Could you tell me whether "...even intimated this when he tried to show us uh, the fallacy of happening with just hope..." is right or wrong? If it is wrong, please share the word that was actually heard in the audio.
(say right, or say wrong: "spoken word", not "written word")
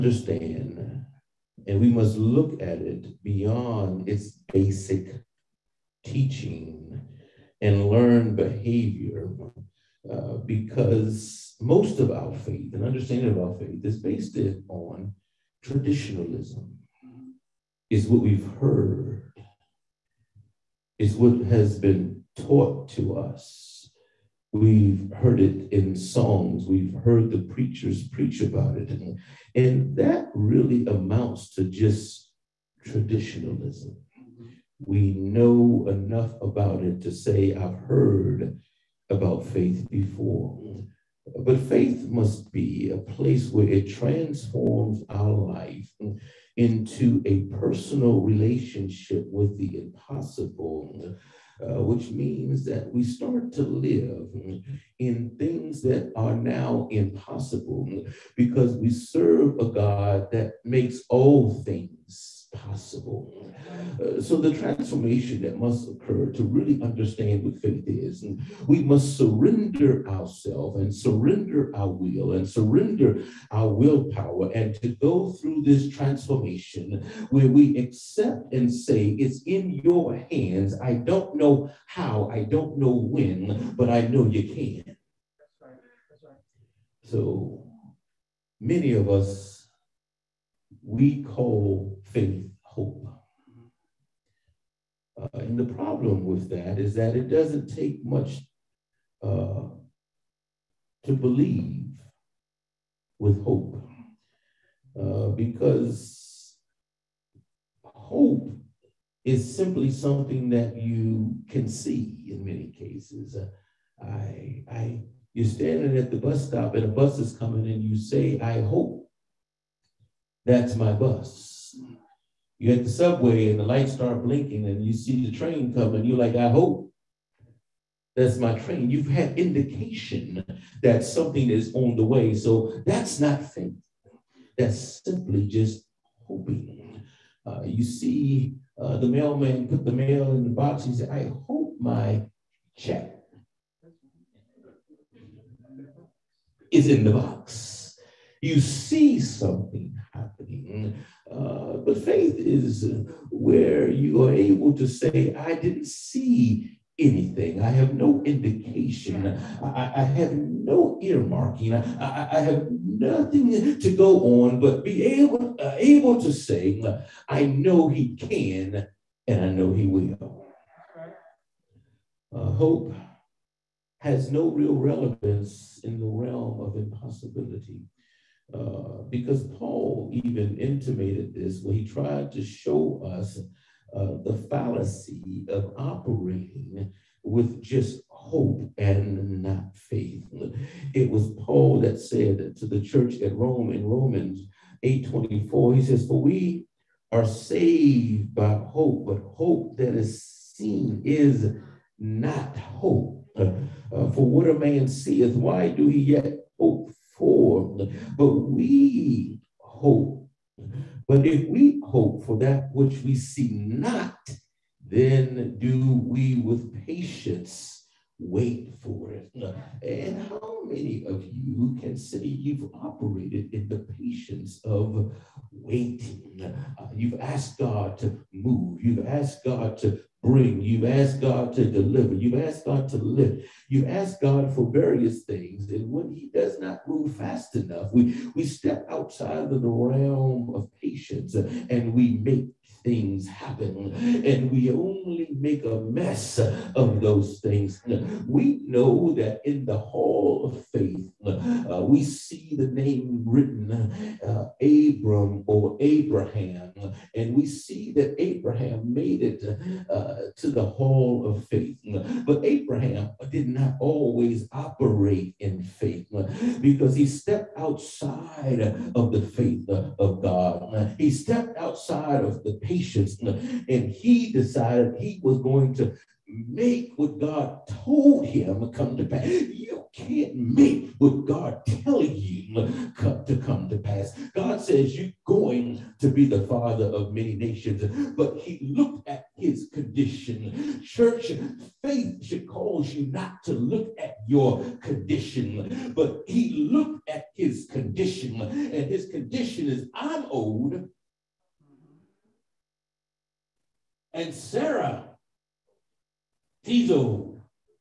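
wrong: "operating", not "happening".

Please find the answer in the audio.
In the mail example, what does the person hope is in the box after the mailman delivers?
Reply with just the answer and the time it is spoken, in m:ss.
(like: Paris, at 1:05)
my check, at 2:21.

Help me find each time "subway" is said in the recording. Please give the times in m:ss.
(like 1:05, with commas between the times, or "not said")
2:02.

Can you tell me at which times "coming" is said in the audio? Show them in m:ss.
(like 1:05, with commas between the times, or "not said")
1:57, 2:05.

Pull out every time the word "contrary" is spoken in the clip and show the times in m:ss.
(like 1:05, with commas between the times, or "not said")
not said.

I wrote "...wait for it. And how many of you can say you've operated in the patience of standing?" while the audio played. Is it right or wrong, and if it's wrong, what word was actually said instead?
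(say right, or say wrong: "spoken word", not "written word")
wrong: "waiting", not "standing".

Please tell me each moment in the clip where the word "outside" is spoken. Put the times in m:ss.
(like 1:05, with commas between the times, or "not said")
3:58, 4:27, 4:31.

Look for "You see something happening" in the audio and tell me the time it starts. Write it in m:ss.
2:28.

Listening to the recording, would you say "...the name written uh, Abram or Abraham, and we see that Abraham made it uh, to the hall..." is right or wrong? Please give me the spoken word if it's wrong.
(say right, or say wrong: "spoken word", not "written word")
right.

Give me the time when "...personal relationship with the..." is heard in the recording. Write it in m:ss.
0:47.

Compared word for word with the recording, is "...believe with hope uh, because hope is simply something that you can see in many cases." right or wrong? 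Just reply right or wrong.
right.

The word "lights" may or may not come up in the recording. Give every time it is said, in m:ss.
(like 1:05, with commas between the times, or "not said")
2:03.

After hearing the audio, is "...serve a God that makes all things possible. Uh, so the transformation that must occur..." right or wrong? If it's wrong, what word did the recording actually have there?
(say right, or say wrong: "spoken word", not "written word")
right.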